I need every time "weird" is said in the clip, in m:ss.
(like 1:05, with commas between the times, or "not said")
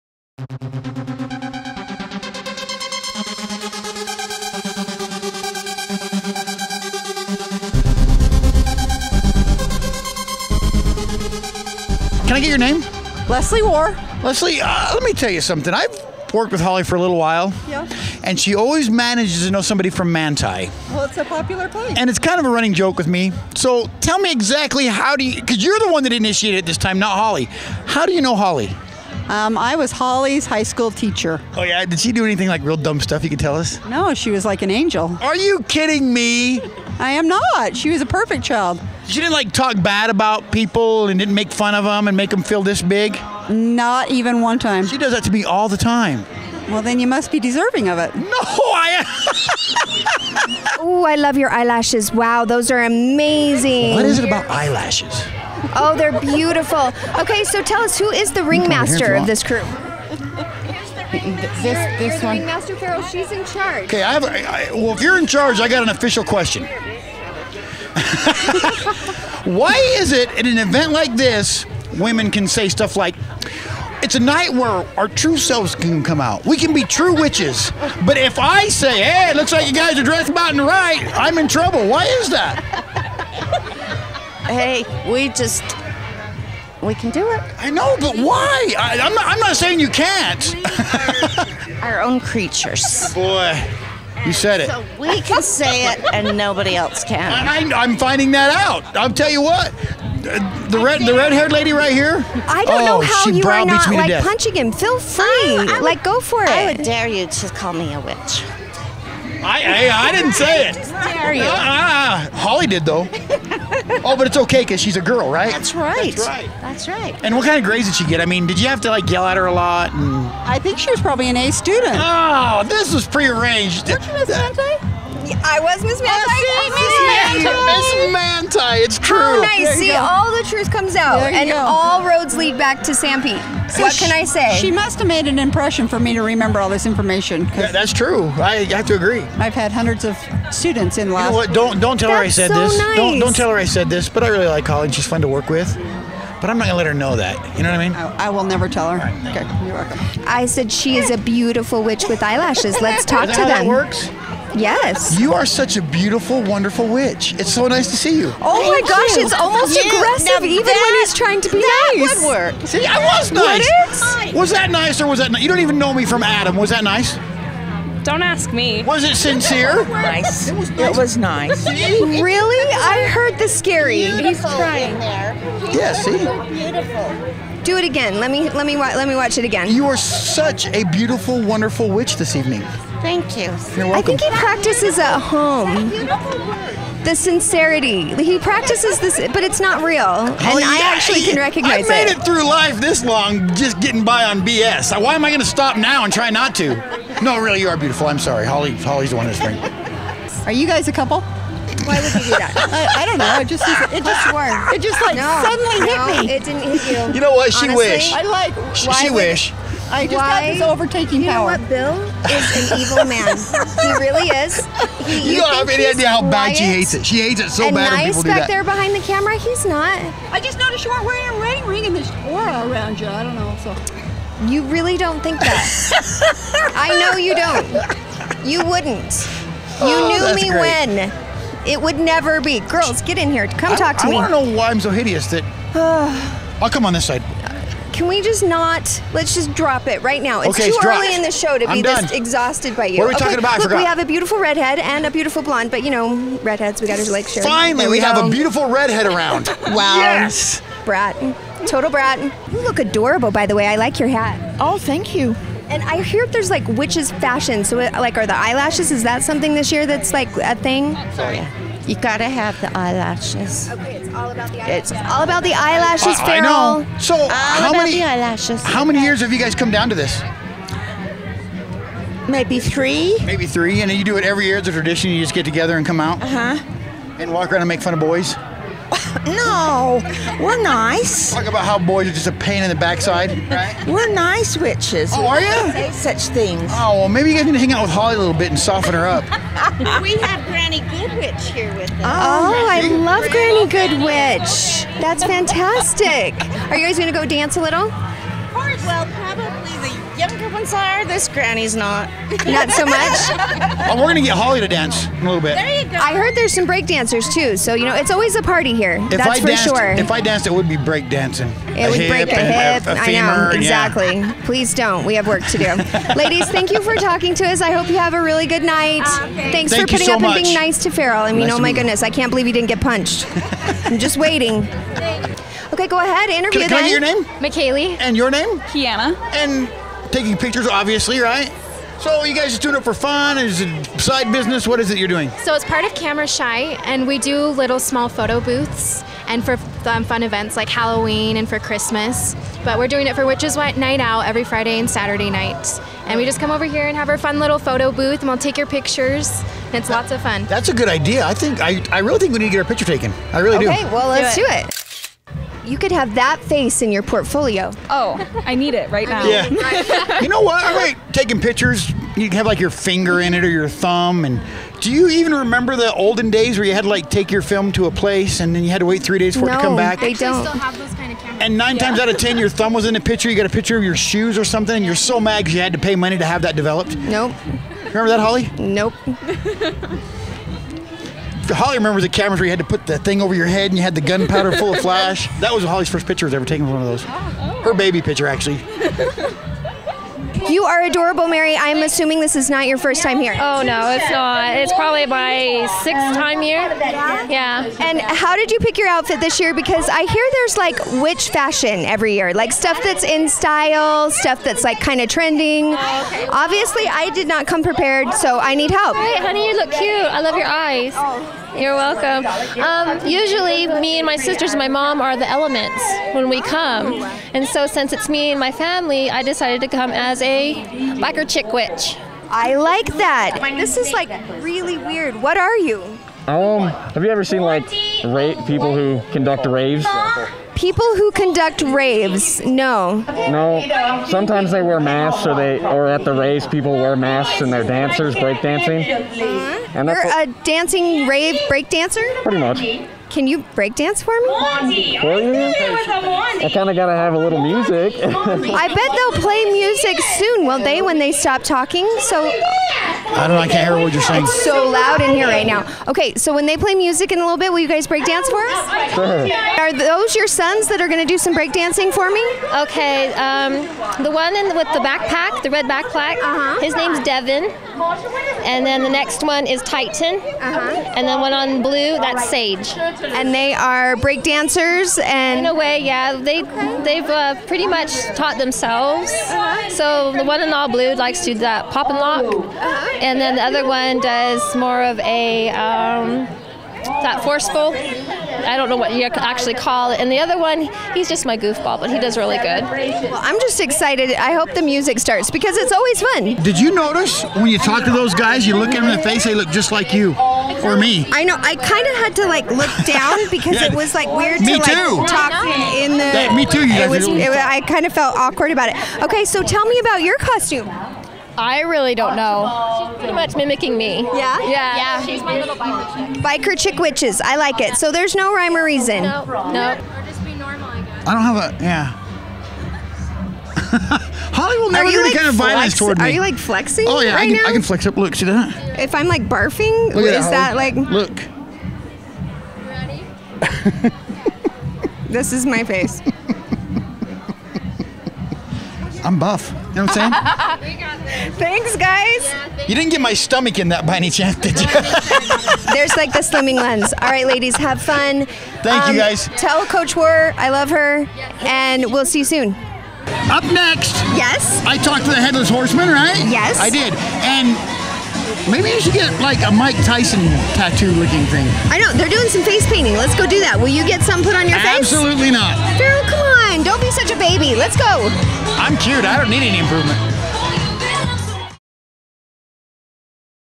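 7:04, 8:24.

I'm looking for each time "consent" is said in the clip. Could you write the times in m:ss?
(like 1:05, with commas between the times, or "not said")
not said.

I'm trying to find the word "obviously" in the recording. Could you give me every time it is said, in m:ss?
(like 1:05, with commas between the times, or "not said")
5:30, 6:45.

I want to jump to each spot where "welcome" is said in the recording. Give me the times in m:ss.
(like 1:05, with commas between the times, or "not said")
2:29, 3:03, 6:51.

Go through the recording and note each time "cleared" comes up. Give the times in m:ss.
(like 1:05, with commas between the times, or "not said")
not said.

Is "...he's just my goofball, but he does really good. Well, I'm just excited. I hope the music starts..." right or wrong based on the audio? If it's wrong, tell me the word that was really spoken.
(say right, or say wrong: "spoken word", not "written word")
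right.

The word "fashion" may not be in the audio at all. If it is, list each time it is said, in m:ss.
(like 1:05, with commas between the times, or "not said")
4:17, 6:41.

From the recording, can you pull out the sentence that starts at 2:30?
I said she is a beautiful witch with eyelashes.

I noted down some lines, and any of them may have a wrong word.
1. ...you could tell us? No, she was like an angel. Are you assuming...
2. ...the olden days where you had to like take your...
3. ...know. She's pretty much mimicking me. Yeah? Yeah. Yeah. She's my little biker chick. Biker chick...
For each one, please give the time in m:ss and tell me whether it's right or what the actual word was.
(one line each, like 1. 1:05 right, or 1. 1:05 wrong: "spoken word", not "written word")
1. 0:33 wrong: "kidding", not "assuming"
2. 6:05 right
3. 8:32 right.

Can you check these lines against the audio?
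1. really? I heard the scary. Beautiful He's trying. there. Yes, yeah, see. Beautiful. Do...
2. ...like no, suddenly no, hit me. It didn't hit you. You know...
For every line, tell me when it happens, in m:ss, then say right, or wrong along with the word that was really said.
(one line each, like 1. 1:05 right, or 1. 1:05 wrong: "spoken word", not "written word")
1. 2:51 right
2. 3:25 right.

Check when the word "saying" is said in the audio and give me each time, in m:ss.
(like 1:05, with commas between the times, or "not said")
1:29, 7:34, 9:00.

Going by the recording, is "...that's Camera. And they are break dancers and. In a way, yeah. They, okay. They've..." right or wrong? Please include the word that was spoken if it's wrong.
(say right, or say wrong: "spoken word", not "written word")
wrong: "Sage", not "Camera".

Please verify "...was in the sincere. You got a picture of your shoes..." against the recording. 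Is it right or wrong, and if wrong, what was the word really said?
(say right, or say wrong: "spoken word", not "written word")
wrong: "picture", not "sincere".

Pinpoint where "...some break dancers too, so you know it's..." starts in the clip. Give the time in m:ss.
5:06.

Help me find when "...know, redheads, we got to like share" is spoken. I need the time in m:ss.
4:05.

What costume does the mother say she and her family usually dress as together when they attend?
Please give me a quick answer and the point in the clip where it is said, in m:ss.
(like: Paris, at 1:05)
the elements, at 6:55.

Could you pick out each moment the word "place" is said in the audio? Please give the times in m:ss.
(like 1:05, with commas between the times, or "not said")
0:21, 6:07.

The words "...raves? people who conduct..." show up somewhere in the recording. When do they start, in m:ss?
7:09.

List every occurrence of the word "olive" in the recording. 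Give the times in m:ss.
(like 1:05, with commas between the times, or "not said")
not said.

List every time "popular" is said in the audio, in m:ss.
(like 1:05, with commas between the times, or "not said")
0:21.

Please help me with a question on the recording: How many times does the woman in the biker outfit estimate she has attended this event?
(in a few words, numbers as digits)
6.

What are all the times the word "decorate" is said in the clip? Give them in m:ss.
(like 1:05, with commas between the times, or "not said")
not said.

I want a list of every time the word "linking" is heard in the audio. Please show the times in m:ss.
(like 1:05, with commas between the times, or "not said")
not said.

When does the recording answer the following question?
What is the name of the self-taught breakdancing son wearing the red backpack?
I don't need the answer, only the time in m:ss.
7:47.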